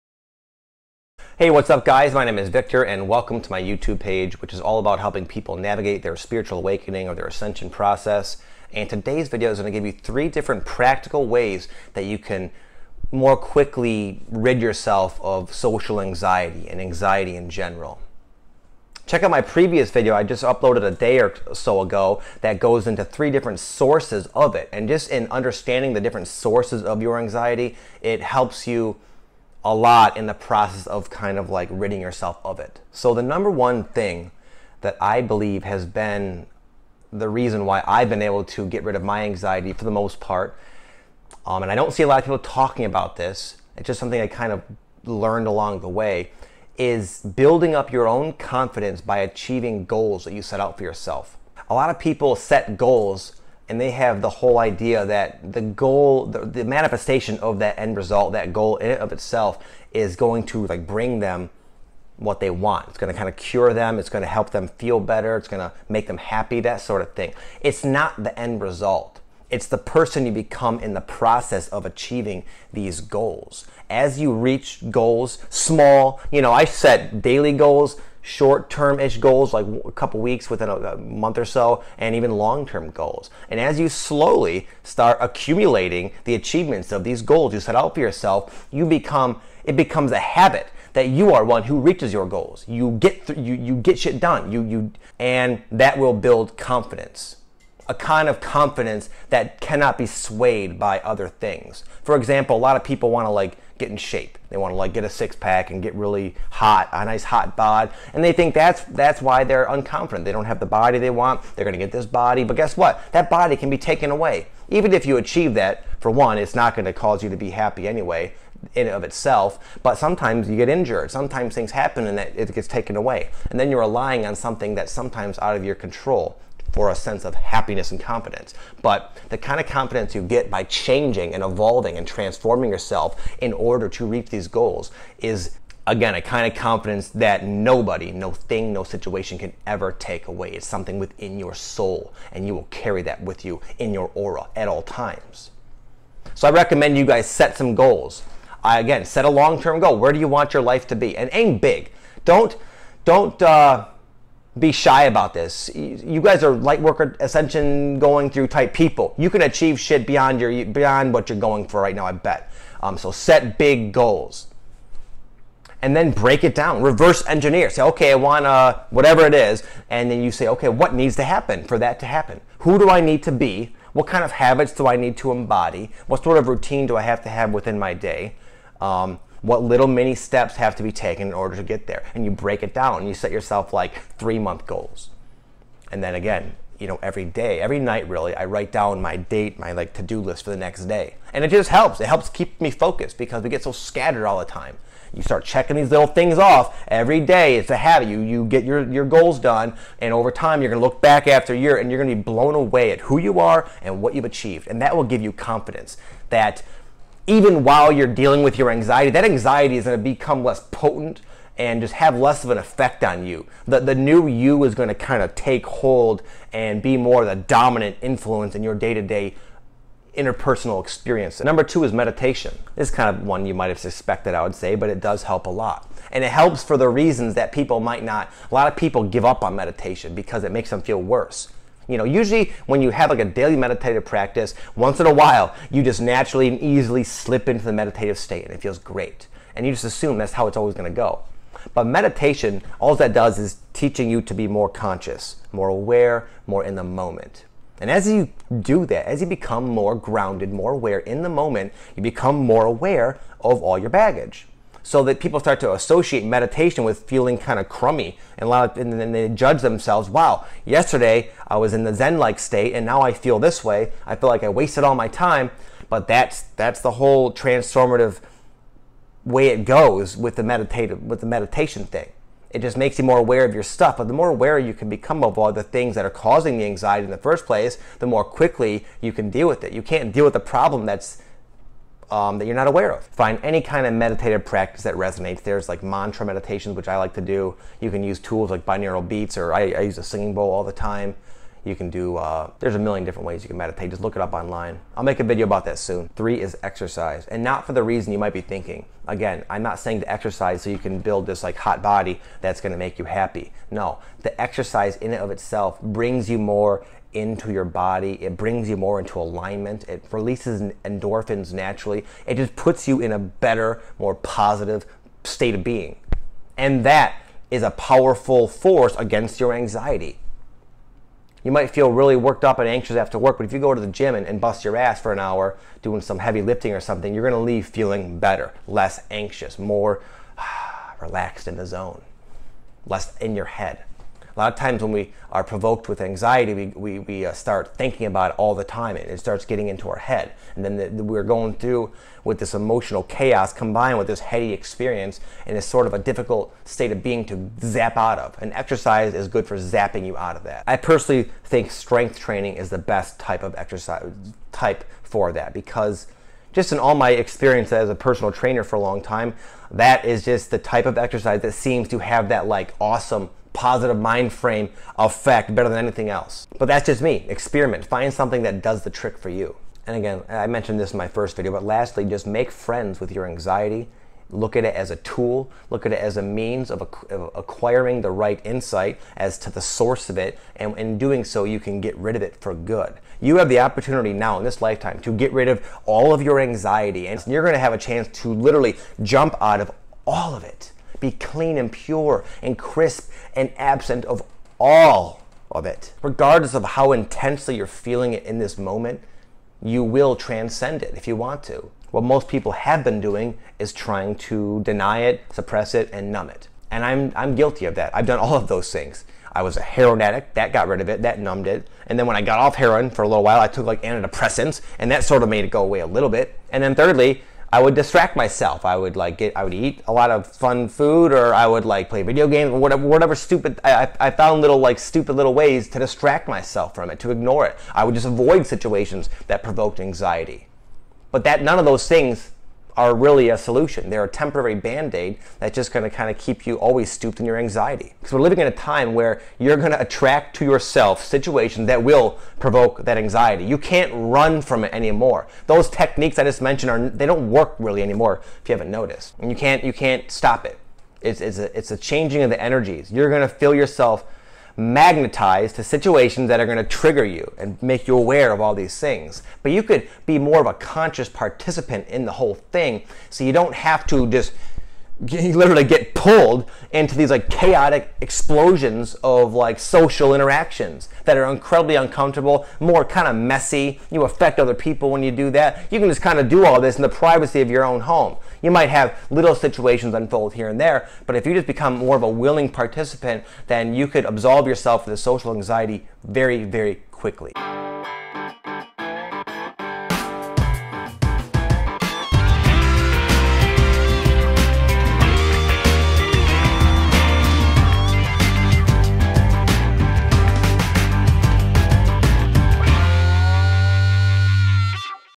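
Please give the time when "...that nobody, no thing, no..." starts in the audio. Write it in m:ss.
2:17.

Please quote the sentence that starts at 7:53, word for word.
You affect other people when you do that.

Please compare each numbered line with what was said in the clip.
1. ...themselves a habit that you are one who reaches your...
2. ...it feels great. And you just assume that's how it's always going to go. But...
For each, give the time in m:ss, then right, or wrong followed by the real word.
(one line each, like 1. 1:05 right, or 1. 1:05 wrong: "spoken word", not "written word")
1. 1:29 wrong: "becomes", not "themselves"
2. 3:58 right.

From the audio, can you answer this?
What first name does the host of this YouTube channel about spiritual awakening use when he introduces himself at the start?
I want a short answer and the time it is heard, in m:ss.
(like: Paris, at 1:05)
Victor, at 0:02.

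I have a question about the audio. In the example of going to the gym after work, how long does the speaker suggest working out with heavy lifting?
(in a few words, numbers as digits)
An hour.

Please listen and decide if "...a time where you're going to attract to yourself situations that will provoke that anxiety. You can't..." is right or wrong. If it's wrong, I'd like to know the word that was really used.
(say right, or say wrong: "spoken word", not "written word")
right.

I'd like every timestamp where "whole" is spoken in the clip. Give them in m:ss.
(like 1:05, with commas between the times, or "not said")
0:54, 4:26, 7:42.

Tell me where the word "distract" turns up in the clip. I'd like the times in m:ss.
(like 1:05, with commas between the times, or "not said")
6:57, 7:05.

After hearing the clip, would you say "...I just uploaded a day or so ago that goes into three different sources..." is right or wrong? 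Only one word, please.
right.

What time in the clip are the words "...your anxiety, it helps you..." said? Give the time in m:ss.
0:27.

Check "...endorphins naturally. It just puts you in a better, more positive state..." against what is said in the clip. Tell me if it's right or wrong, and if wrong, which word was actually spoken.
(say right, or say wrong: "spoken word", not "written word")
right.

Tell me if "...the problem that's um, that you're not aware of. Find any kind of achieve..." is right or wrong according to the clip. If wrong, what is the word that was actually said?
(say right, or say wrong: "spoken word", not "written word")
wrong: "meditative", not "achieve".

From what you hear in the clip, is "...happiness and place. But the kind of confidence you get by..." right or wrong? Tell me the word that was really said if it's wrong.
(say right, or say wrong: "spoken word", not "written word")
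wrong: "confidence", not "place".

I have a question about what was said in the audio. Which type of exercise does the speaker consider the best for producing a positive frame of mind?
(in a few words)
Strength training.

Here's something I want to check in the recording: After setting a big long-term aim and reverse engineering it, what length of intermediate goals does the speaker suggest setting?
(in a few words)
3 month goals.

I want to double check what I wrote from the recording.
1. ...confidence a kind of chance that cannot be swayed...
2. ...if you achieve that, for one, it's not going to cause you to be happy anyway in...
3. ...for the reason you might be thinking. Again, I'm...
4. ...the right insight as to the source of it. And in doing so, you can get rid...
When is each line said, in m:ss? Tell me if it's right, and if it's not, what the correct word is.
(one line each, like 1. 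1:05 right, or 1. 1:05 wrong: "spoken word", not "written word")
1. 1:36 wrong: "confidence", not "chance"
2. 1:54 right
3. 4:57 right
4. 6:18 right.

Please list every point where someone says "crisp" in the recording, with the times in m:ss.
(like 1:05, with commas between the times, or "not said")
6:32.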